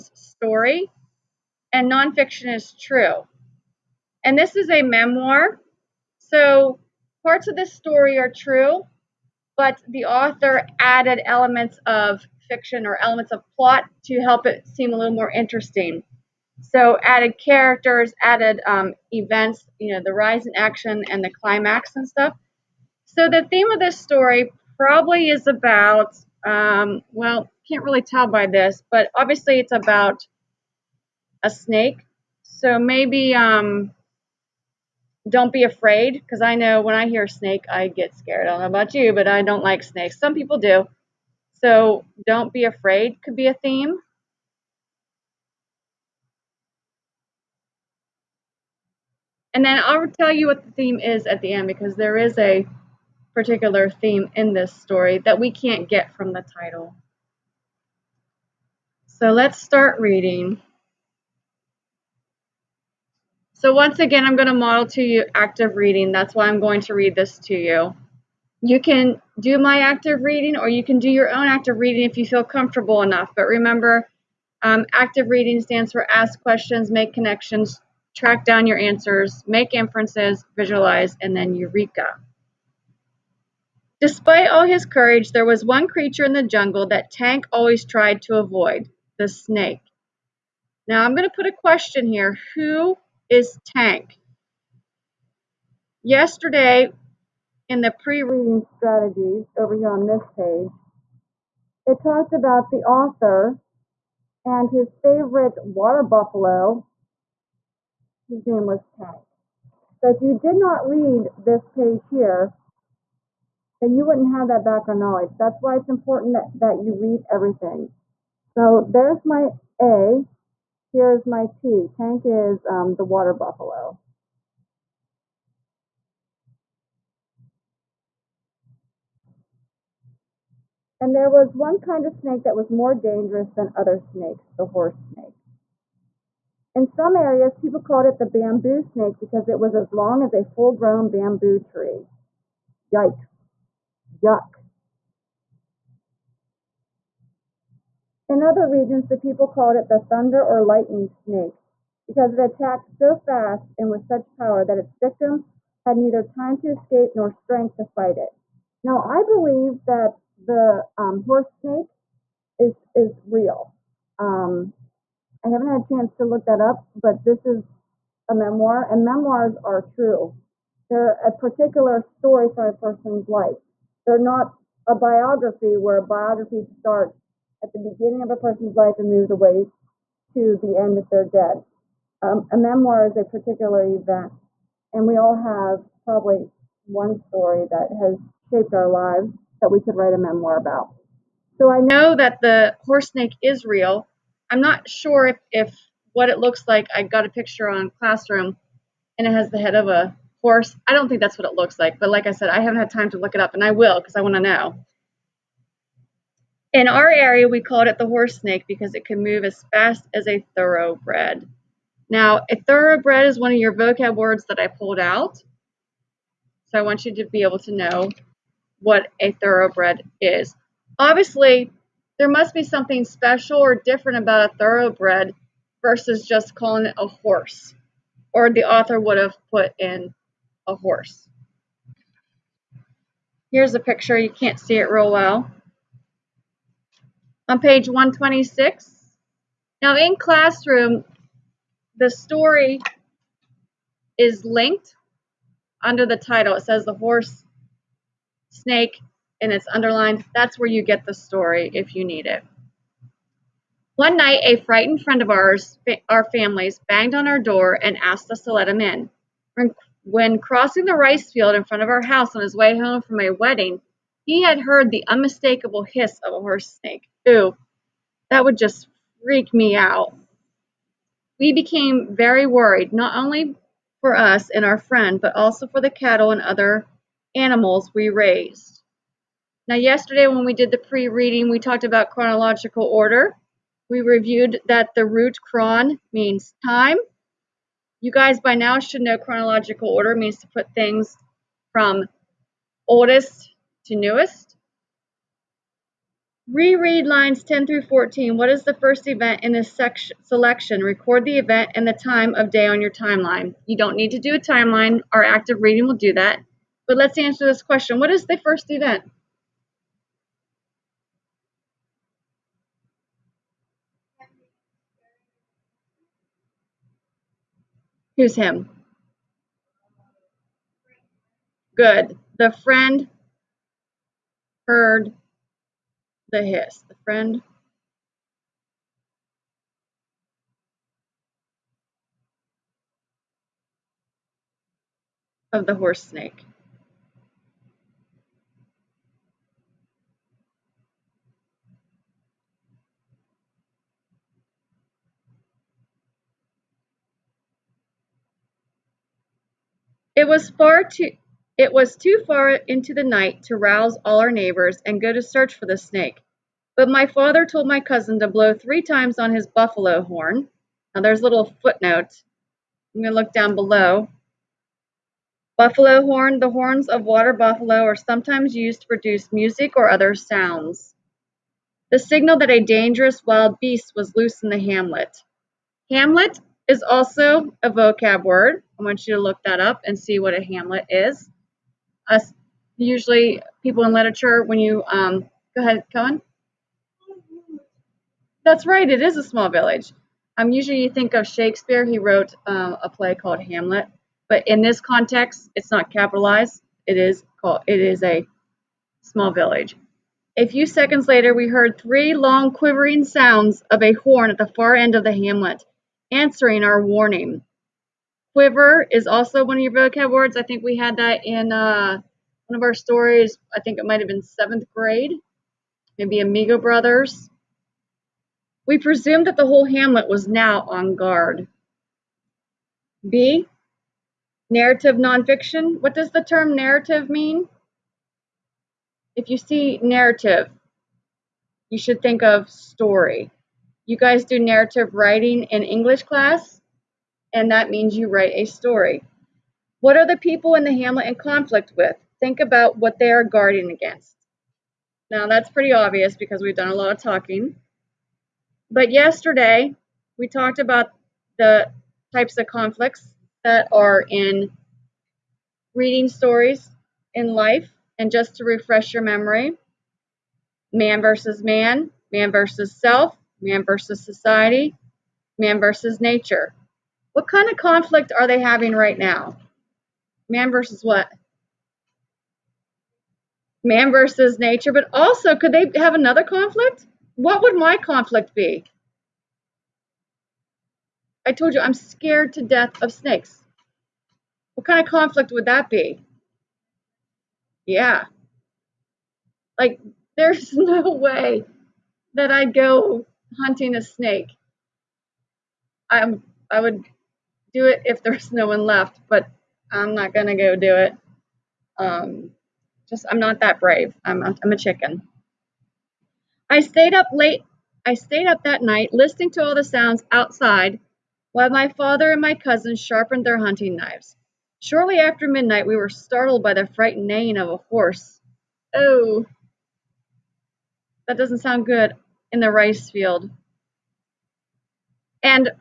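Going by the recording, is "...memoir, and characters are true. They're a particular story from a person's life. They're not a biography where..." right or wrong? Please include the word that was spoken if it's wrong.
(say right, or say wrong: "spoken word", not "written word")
wrong: "memoirs", not "characters".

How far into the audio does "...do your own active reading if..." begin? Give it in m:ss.
1:10.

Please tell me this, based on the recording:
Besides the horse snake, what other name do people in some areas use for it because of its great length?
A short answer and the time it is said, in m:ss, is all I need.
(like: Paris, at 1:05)
bamboo snake, at 2:18.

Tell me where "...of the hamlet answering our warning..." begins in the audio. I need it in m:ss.
6:44.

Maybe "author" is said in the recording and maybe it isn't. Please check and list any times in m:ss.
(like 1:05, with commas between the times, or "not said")
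0:10, 1:42, 3:48.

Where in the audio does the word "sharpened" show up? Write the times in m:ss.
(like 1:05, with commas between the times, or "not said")
8:32.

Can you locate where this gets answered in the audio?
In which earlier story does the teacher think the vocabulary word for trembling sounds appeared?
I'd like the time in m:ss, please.
6:56.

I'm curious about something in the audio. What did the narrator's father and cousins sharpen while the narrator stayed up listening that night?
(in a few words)
hunting knives.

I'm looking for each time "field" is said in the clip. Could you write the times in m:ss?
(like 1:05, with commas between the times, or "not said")
4:21, 8:42.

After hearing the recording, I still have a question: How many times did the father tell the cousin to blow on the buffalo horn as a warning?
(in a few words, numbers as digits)
3.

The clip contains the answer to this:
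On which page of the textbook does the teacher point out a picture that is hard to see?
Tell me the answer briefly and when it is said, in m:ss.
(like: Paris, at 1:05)
126, at 3:57.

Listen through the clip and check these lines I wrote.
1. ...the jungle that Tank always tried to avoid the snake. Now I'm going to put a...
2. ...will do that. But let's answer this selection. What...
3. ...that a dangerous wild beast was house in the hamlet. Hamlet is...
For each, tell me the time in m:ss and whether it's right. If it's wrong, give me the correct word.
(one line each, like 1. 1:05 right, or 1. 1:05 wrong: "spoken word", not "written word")
1. 1:26 right
2. 5:05 wrong: "question", not "selection"
3. 6:12 wrong: "loose", not "house".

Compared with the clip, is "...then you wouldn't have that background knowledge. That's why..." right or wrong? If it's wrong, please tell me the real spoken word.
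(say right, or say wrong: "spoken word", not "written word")
right.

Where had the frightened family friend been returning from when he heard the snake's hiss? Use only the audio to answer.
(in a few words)
a wedding.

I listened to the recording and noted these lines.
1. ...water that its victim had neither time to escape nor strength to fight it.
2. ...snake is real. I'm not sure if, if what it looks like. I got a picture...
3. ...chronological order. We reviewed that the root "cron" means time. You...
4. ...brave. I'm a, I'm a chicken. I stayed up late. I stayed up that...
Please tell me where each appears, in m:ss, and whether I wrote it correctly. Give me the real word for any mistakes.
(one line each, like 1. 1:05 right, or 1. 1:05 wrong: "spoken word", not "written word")
1. 2:34 wrong: "power", not "water"
2. 3:13 right
3. 4:42 right
4. 8:23 right.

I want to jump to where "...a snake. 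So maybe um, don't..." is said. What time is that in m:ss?
0:31.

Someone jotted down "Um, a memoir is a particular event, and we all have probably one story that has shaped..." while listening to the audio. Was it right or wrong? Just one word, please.
right.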